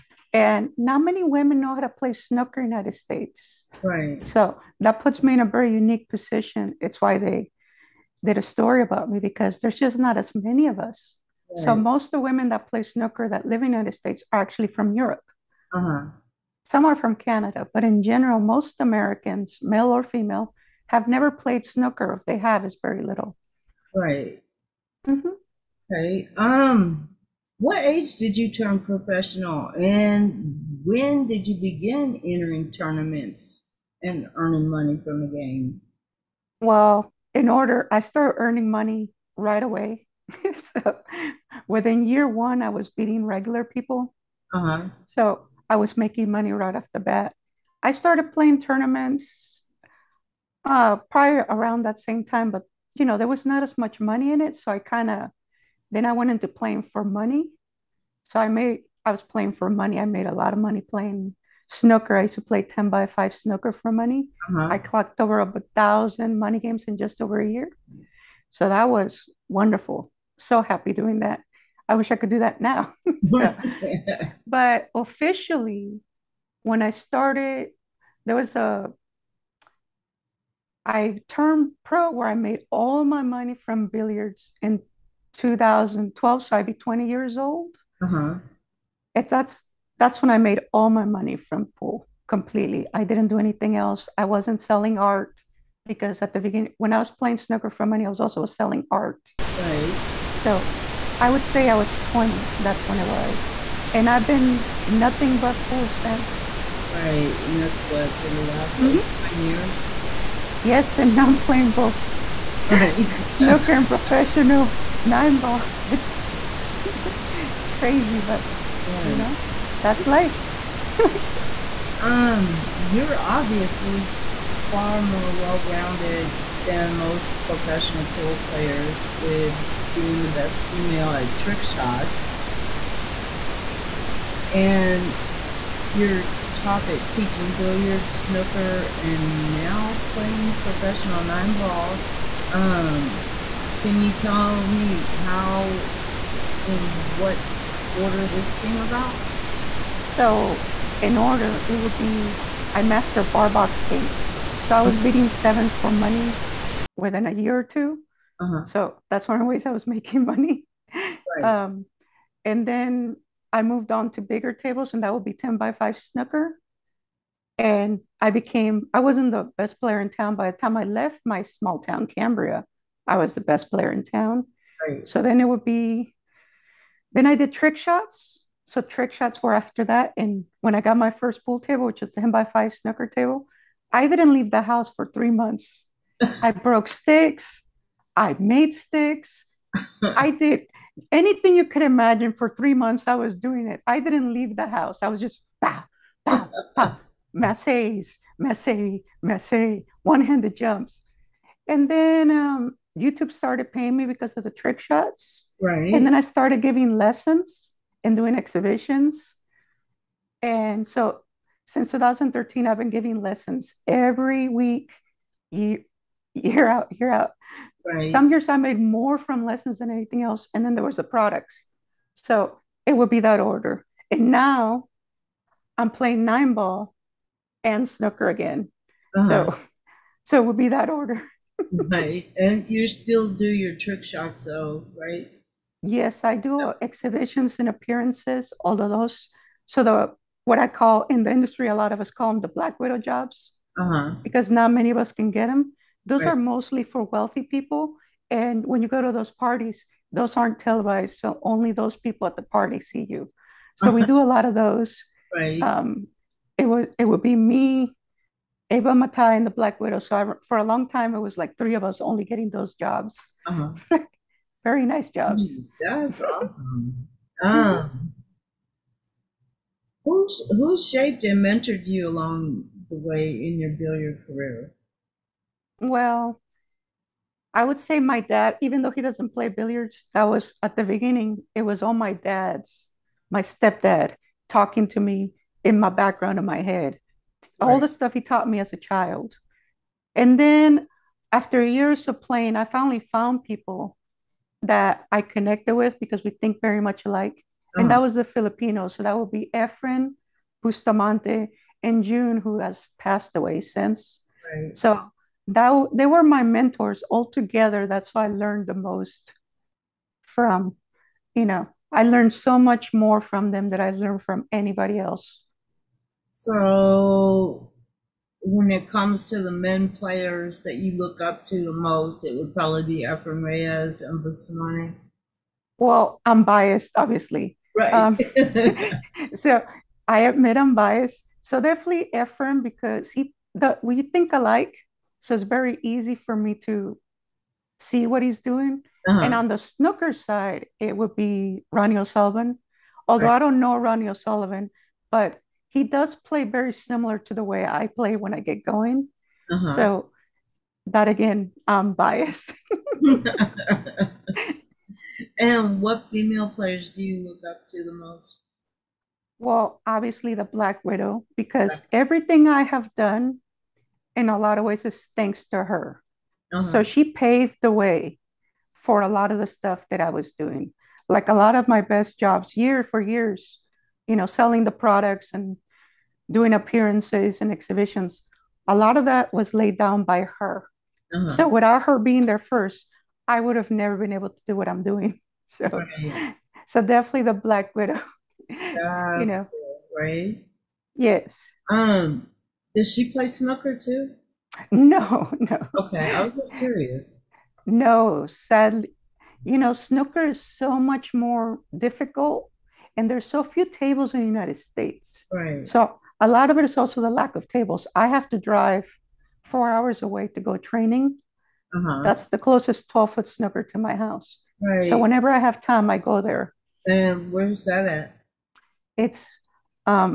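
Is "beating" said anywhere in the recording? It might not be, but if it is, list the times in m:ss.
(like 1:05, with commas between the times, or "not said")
0:42, 2:34.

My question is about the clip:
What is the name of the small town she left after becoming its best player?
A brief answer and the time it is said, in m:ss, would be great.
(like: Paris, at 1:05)
Cambria, at 2:52.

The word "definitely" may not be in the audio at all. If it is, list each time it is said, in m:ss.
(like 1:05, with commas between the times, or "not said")
5:31, 6:26.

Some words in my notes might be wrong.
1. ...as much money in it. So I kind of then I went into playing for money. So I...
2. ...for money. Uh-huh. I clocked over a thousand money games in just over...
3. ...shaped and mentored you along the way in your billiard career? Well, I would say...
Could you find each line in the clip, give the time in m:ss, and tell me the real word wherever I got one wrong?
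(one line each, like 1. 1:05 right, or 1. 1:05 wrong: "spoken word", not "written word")
1. 0:53 right
2. 1:03 right
3. 4:30 right.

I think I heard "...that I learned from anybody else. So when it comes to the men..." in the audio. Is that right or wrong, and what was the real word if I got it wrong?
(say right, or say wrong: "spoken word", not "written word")
right.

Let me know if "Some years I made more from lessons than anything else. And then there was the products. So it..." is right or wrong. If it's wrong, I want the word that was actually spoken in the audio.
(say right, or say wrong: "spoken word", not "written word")
right.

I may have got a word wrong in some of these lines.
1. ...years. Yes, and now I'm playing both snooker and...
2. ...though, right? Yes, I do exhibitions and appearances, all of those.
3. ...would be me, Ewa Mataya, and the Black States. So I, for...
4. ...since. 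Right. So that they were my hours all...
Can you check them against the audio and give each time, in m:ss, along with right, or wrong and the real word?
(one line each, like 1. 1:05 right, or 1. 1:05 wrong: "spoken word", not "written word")
1. 1:49 right
2. 3:54 right
3. 4:17 wrong: "Widow", not "States"
4. 5:03 wrong: "mentors", not "hours".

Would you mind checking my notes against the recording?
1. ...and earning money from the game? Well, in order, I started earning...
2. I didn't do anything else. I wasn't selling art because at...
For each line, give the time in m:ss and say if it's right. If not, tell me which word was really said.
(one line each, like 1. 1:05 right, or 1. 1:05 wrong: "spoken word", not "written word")
1. 0:34 right
2. 1:32 right.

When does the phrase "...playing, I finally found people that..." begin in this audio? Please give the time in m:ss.
4:52.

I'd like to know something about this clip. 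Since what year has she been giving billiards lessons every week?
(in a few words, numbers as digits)
2013.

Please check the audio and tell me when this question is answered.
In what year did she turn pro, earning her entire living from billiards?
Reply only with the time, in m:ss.
1:25.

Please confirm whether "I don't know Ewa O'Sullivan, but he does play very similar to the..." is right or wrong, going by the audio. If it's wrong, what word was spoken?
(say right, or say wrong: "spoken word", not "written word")
wrong: "Ronnie", not "Ewa".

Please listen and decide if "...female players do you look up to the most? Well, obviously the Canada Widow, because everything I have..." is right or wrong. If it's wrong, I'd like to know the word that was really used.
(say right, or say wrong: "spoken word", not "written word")
wrong: "Black", not "Canada".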